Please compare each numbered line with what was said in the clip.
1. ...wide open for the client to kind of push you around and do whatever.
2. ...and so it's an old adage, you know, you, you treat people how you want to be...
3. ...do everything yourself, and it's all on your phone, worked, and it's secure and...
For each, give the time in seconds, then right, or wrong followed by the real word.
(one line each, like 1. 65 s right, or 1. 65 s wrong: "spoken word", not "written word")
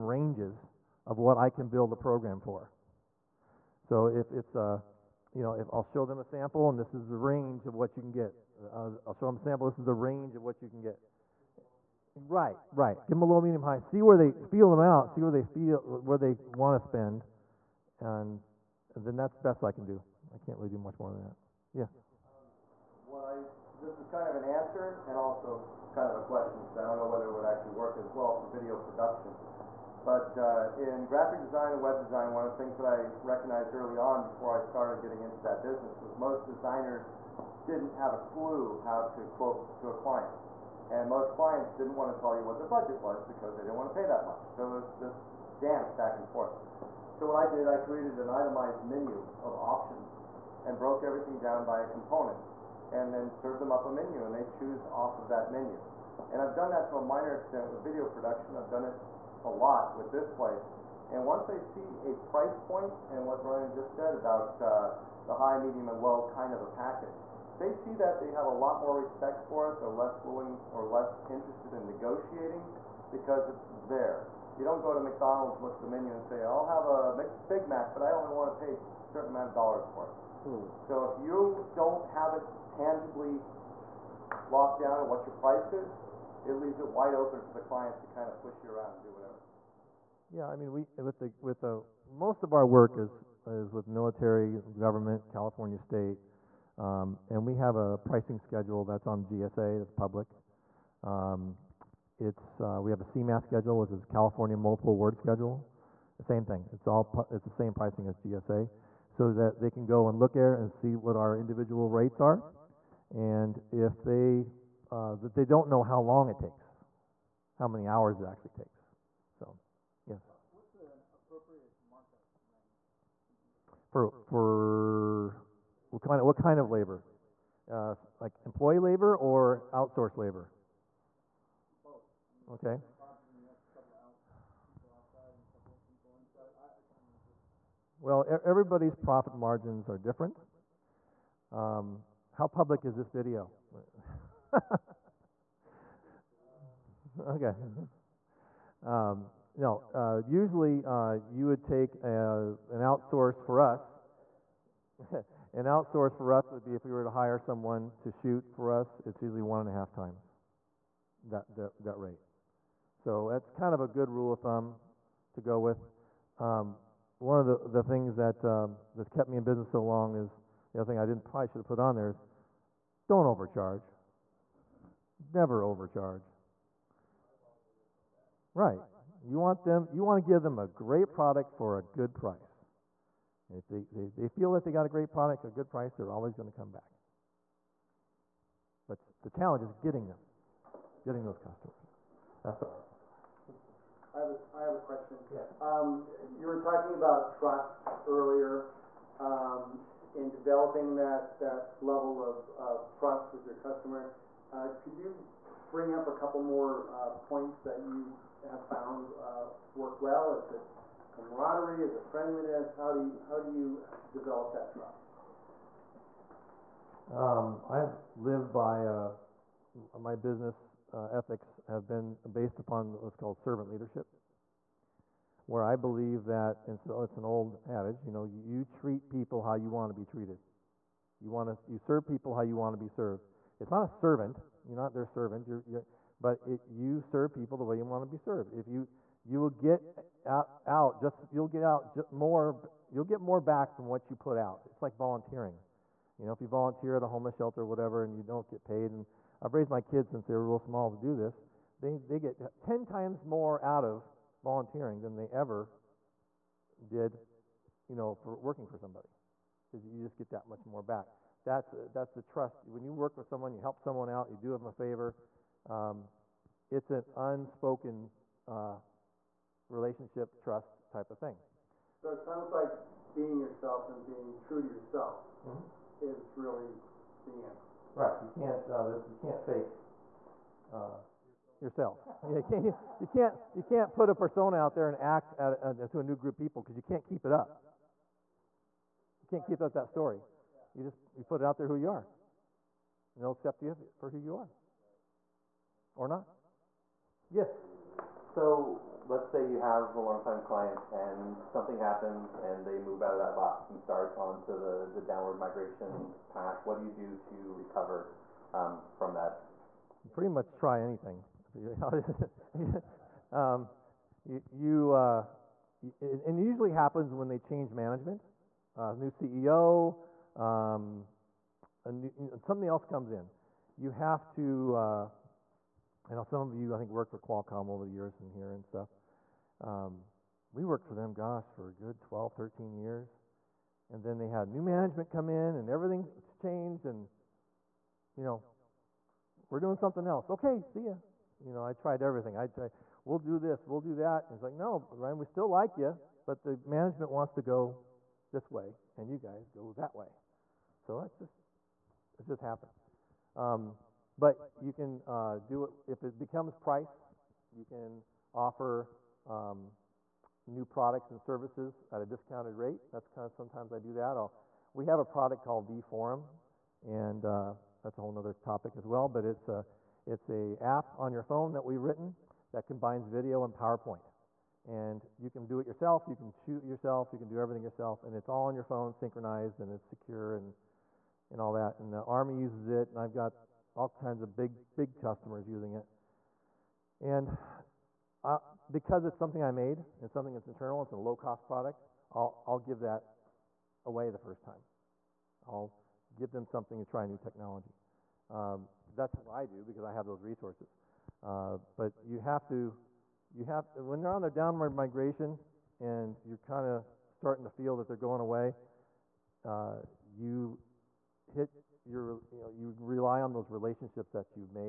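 1. 86 s right
2. 226 s right
3. 377 s wrong: "synchronized", not "worked".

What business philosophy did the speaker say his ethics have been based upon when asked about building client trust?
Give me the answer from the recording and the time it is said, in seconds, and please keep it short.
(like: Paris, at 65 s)
Servant leadership, at 223 s.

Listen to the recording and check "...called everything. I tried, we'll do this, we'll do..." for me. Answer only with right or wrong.
wrong.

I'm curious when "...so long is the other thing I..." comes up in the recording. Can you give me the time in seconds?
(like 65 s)
169 s.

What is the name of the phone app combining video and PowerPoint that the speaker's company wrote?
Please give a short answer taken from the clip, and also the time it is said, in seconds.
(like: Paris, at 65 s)
vForum, at 365 s.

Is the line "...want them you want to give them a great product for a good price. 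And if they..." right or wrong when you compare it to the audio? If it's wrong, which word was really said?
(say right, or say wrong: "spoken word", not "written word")
right.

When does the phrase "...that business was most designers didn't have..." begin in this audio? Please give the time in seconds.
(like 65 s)
35 s.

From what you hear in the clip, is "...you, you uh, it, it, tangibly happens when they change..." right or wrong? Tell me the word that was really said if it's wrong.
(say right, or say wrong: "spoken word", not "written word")
wrong: "usually", not "tangibly".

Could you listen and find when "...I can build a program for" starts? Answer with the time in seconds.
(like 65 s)
1 s.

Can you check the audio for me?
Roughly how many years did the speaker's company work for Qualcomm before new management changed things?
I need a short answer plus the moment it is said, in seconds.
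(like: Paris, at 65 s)
12 or 13 years, at 331 s.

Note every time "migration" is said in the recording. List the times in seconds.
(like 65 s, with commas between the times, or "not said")
305 s, 404 s.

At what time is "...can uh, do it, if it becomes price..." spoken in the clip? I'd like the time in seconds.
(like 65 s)
354 s.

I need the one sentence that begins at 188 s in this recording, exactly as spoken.
But the challenge is getting them, getting those customers.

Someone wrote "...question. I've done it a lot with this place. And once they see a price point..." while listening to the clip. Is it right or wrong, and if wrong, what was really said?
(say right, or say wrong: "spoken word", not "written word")
wrong: "production", not "question".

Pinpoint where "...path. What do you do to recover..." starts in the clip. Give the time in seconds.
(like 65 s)
306 s.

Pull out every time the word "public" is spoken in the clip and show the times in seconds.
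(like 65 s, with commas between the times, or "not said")
99 s, 142 s.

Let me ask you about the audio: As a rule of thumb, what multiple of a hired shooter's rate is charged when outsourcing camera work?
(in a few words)
1.5 times.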